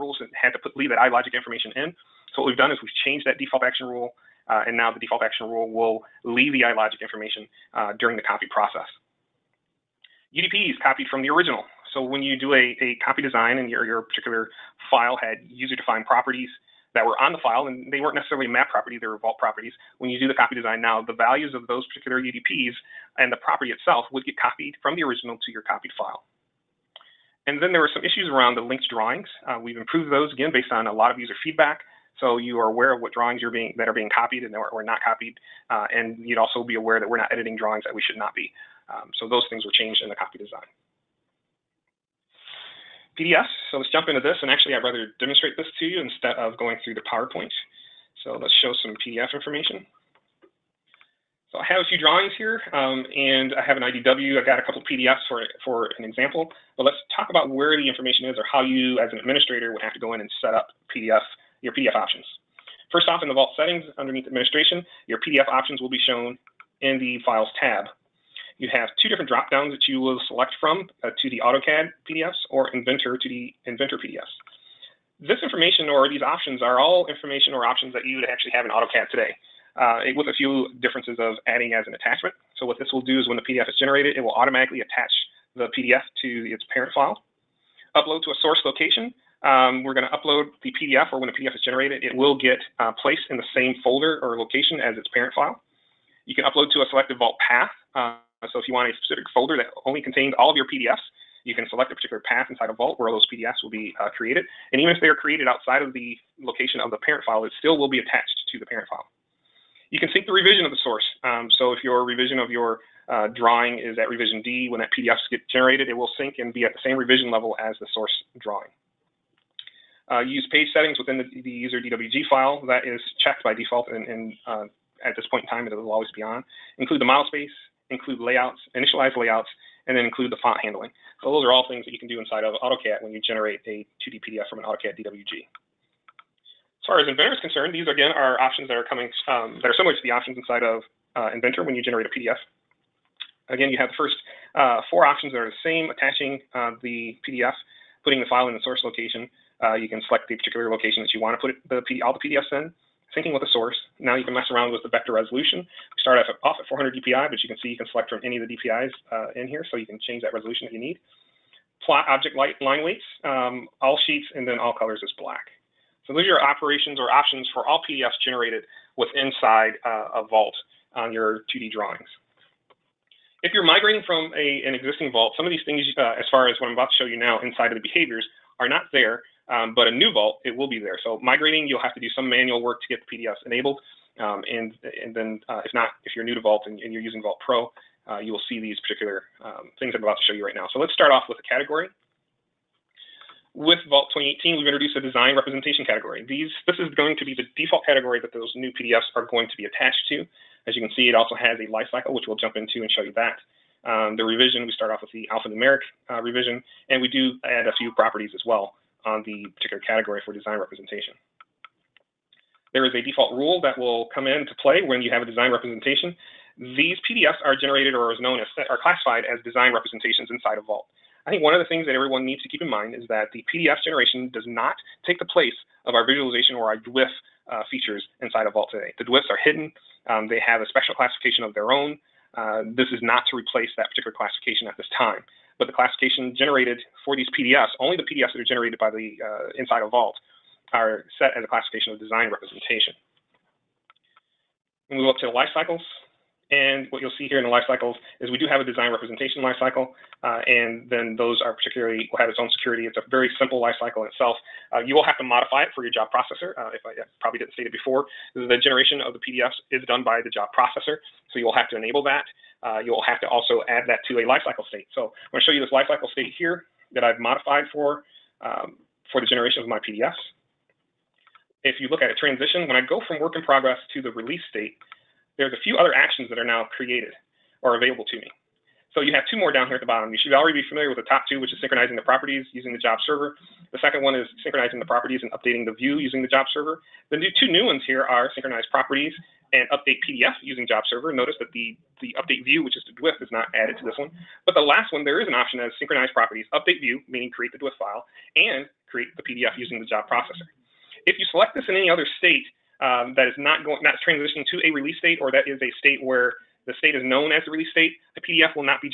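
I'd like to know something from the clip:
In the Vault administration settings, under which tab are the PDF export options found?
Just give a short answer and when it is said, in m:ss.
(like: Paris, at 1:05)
Files tab, at 1:07.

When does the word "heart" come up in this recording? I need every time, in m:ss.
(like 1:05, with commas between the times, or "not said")
not said.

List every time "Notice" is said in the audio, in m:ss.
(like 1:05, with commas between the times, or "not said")
4:51.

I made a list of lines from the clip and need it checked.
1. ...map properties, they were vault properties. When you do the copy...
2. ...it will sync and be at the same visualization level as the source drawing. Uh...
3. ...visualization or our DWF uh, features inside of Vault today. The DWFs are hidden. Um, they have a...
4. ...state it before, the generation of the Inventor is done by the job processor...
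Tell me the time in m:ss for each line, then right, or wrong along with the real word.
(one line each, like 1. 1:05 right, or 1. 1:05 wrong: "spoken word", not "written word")
1. 0:18 right
2. 1:55 wrong: "revision", not "visualization"
3. 3:46 right
4. 4:17 wrong: "PDFs", not "Inventor".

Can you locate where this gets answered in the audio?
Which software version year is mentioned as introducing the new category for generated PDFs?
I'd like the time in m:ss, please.
3:13.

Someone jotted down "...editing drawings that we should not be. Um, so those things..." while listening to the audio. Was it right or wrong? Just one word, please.
right.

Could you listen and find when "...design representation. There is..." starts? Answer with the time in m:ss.
3:30.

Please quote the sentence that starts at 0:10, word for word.
UDP is copied from the original.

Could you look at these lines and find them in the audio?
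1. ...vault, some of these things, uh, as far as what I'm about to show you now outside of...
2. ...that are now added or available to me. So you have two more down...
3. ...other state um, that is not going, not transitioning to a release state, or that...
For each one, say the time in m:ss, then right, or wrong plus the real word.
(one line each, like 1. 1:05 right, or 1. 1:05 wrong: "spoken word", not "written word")
1. 2:55 wrong: "inside", not "outside"
2. 4:36 wrong: "created", not "added"
3. 5:01 right.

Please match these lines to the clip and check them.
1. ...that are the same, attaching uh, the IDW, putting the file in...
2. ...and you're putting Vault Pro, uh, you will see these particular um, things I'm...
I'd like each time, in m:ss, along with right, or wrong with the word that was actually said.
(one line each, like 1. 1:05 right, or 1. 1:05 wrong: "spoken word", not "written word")
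1. 2:25 wrong: "PDF", not "IDW"
2. 3:06 wrong: "using", not "putting".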